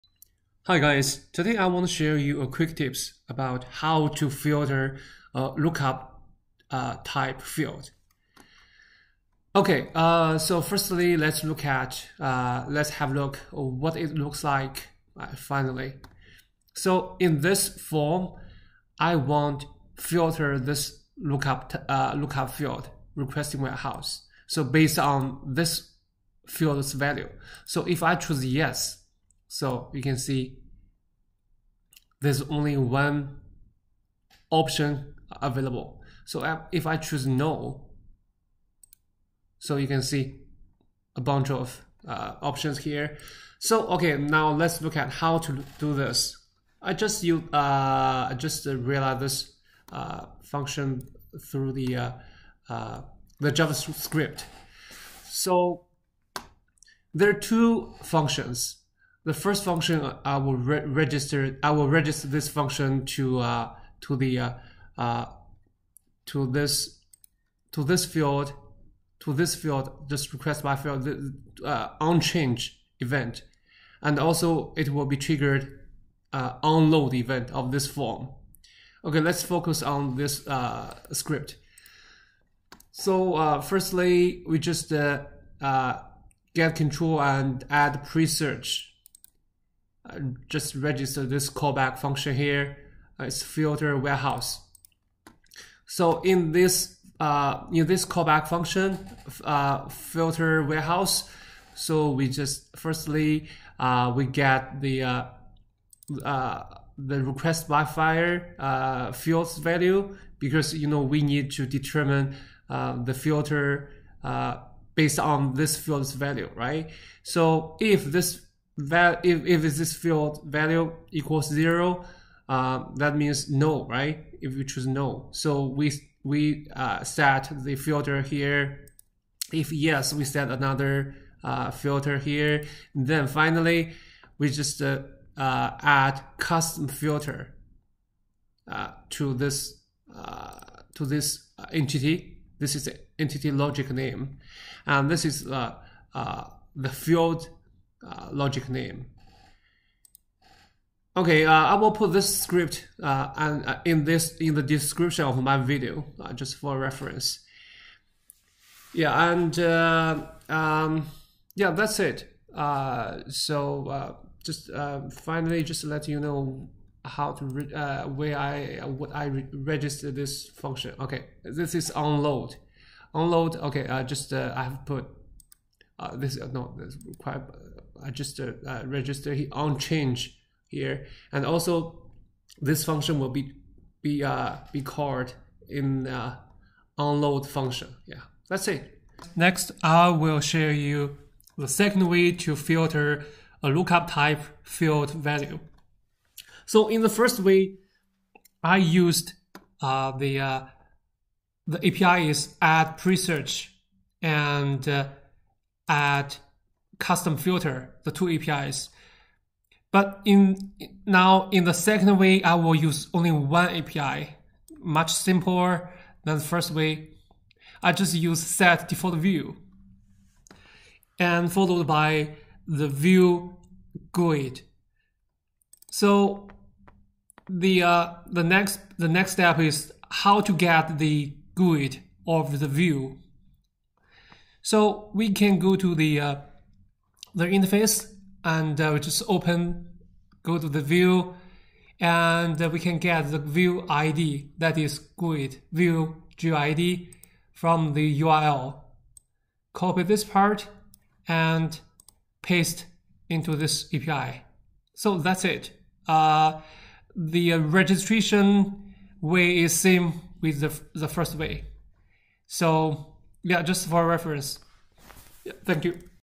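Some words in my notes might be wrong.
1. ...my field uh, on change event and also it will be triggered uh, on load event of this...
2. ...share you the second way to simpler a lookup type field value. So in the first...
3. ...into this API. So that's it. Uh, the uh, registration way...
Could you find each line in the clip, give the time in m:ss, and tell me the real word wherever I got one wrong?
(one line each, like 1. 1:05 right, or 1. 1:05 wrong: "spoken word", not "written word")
1. 1:10 right
2. 3:10 wrong: "filter", not "simpler"
3. 4:13 right.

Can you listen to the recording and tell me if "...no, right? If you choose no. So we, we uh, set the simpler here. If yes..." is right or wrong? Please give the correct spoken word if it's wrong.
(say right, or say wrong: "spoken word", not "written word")
wrong: "filter", not "simpler".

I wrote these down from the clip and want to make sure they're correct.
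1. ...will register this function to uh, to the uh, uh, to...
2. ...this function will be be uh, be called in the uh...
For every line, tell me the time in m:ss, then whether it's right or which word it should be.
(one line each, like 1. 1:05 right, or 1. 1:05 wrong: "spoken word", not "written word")
1. 1:01 right
2. 3:02 right.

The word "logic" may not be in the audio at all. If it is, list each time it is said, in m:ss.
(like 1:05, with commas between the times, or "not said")
2:23, 2:28.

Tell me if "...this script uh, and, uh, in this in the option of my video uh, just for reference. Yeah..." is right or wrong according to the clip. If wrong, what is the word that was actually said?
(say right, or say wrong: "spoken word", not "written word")
wrong: "description", not "option".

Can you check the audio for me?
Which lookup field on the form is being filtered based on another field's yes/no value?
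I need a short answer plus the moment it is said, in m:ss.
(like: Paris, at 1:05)
Requesting warehouse, at 0:23.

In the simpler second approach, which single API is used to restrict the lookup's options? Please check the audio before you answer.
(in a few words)
set default view.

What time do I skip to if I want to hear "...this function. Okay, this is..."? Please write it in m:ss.
2:50.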